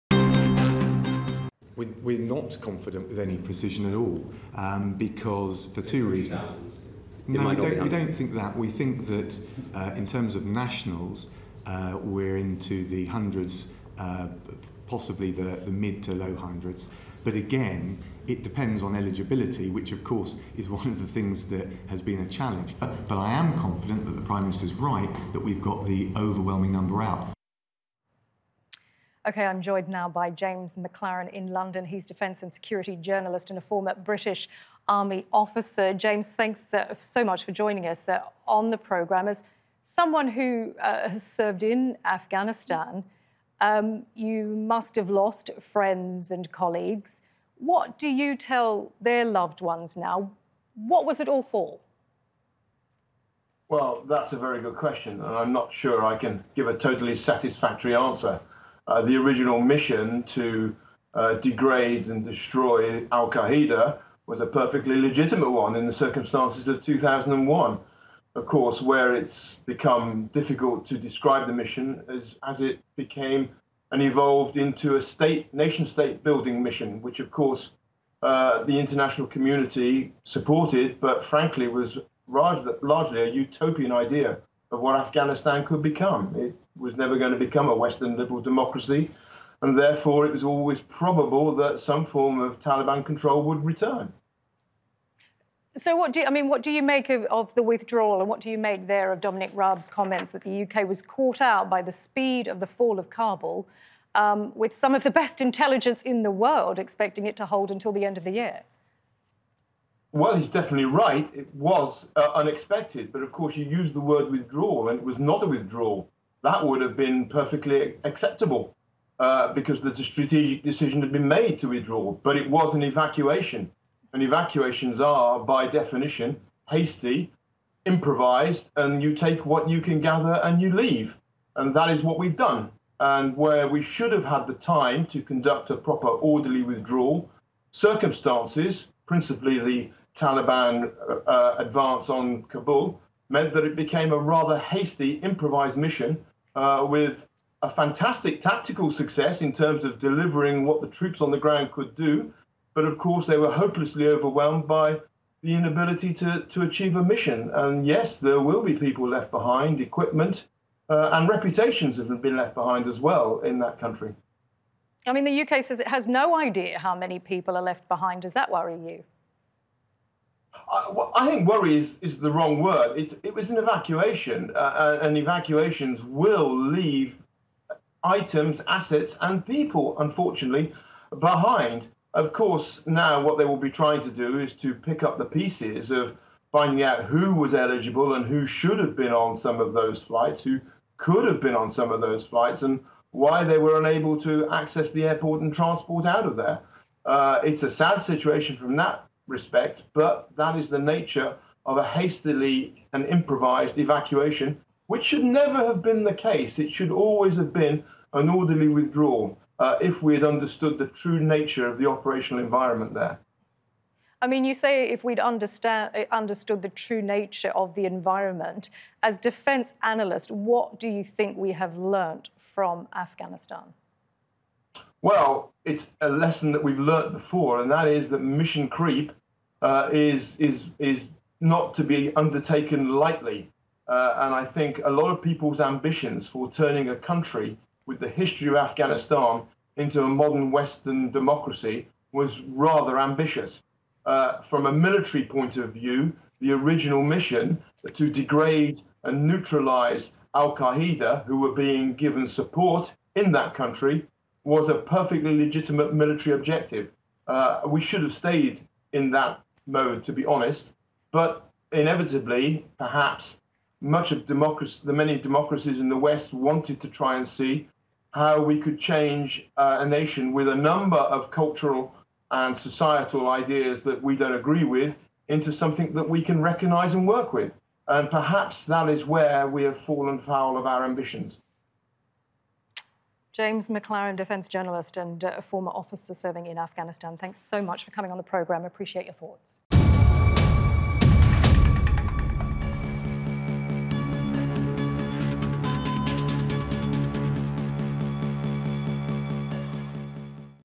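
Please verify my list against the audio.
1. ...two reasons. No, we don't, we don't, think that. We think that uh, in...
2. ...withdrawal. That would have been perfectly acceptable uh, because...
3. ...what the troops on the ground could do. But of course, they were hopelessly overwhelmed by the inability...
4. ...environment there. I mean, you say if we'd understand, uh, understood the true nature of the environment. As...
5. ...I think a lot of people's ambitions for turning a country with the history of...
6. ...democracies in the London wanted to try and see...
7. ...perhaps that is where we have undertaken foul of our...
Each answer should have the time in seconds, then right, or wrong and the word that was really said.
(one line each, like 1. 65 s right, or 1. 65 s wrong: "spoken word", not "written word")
1. 5 s right
2. 115 s right
3. 150 s right
4. 212 s right
5. 234 s right
6. 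265 s wrong: "West", not "London"
7. 278 s wrong: "fallen", not "undertaken".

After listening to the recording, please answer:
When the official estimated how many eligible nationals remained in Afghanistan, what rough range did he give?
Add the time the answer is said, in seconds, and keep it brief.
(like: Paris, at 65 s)
mid to low hundreds, at 15 s.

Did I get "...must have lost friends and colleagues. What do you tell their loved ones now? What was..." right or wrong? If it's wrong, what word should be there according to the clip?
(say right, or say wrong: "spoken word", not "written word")
right.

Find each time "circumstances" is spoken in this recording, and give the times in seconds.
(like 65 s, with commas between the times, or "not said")
65 s, 137 s.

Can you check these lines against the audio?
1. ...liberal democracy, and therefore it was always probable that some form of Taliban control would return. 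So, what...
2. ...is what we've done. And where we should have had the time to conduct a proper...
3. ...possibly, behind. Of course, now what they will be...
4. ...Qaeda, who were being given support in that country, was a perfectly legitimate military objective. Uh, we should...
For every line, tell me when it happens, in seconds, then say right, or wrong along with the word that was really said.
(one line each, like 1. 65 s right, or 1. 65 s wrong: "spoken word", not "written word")
1. 88 s right
2. 131 s right
3. 179 s wrong: "unfortunately", not "possibly"
4. 250 s right.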